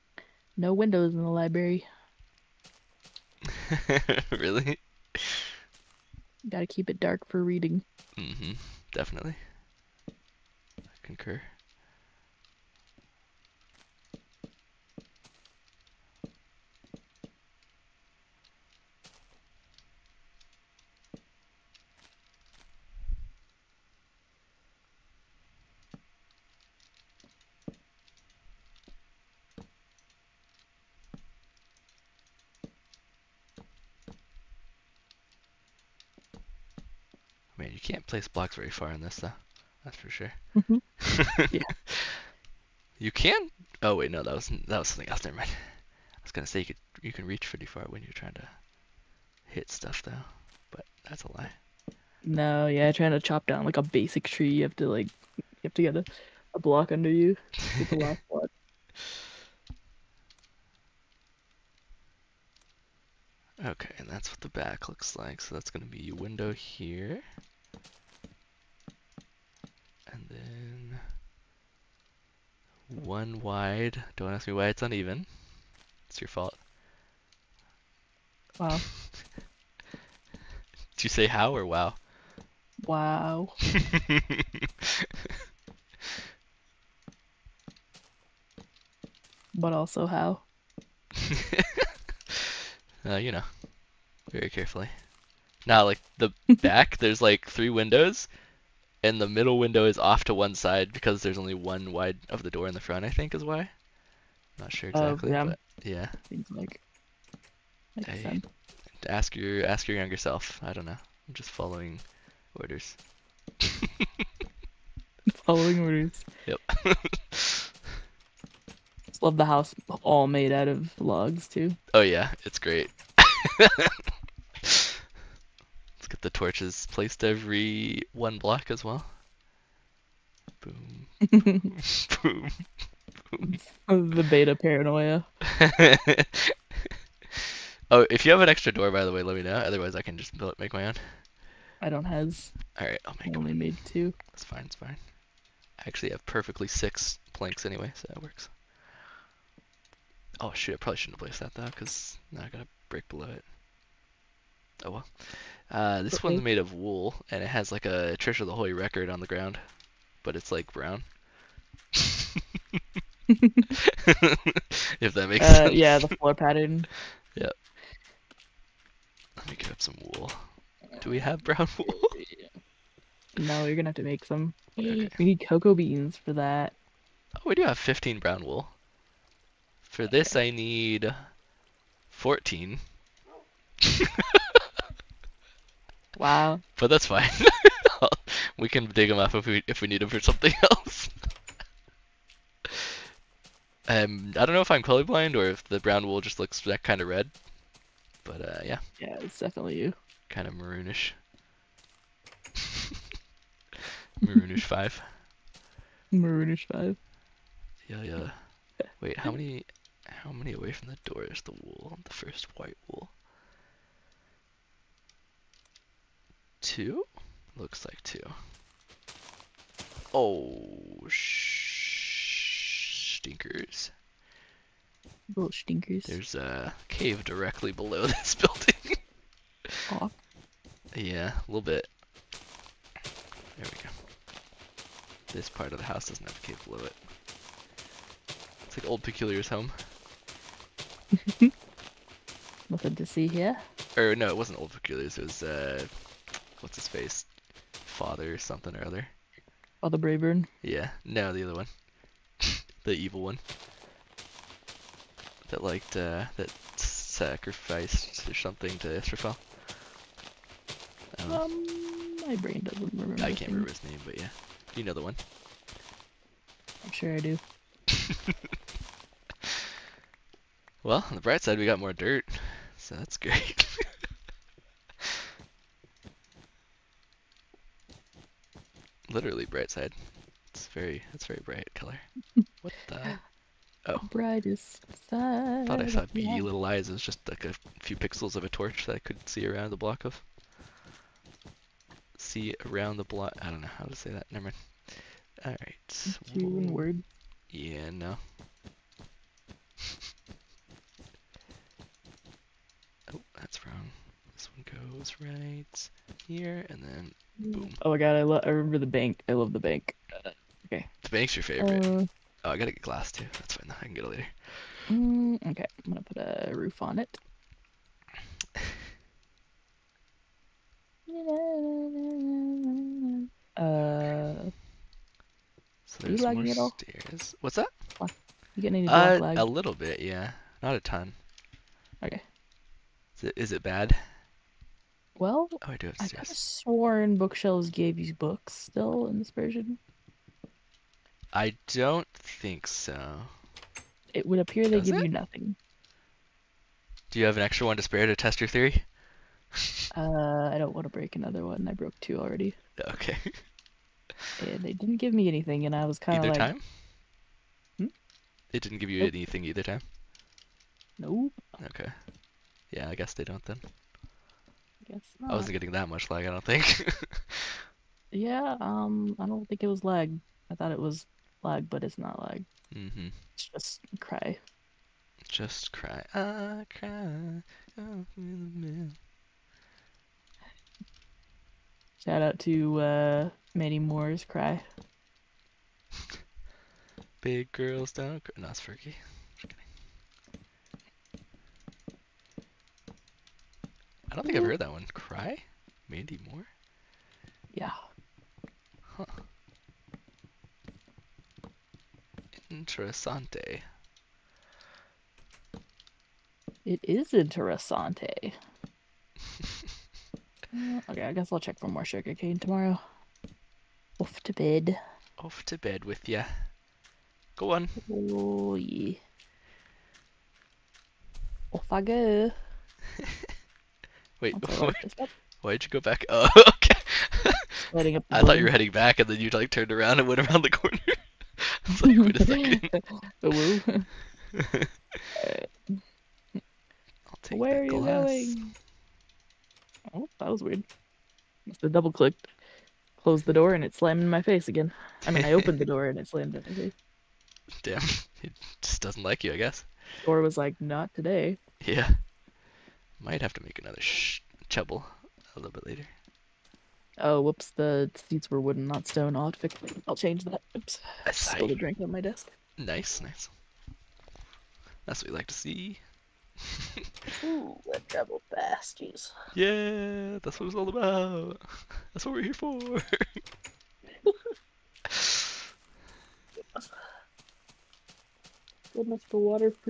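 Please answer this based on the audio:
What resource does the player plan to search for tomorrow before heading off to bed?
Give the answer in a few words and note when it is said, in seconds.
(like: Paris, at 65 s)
Sugarcane, at 411 s.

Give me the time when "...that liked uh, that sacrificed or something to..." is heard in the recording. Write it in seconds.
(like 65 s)
255 s.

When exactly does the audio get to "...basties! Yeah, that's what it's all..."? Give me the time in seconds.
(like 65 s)
468 s.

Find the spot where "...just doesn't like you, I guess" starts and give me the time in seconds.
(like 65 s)
448 s.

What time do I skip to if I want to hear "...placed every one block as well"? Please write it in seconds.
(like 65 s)
126 s.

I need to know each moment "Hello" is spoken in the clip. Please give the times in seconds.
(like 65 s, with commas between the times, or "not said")
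433 s.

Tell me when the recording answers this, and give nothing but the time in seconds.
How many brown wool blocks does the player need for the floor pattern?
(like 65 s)
180 s.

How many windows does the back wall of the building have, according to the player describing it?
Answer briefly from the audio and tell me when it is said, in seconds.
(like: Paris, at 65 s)
3, at 97 s.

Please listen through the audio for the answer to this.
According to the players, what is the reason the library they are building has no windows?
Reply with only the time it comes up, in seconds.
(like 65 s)
6 s.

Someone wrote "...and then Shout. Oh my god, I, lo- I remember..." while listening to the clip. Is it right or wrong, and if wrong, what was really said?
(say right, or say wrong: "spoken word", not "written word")
wrong: "Boom", not "Shout".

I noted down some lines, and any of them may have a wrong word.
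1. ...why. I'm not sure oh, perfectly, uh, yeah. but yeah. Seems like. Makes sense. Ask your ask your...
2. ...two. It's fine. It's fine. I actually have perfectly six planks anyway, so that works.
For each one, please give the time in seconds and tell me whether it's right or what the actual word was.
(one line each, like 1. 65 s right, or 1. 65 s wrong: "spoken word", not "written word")
1. 103 s wrong: "exactly", not "perfectly"
2. 143 s right.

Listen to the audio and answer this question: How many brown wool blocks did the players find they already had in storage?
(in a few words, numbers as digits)
15.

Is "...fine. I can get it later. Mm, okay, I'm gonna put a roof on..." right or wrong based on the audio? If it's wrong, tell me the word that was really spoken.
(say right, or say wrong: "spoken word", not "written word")
right.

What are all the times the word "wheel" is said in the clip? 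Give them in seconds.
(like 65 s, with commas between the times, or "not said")
not said.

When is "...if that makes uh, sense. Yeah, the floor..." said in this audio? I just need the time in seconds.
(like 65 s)
163 s.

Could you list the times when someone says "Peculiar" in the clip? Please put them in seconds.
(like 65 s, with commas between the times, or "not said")
239 s, 244 s.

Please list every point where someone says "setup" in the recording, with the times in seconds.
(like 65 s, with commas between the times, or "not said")
not said.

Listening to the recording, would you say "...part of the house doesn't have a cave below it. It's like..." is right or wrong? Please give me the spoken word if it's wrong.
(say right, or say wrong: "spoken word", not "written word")
right.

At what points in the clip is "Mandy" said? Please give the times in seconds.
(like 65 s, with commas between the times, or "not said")
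383 s, 395 s.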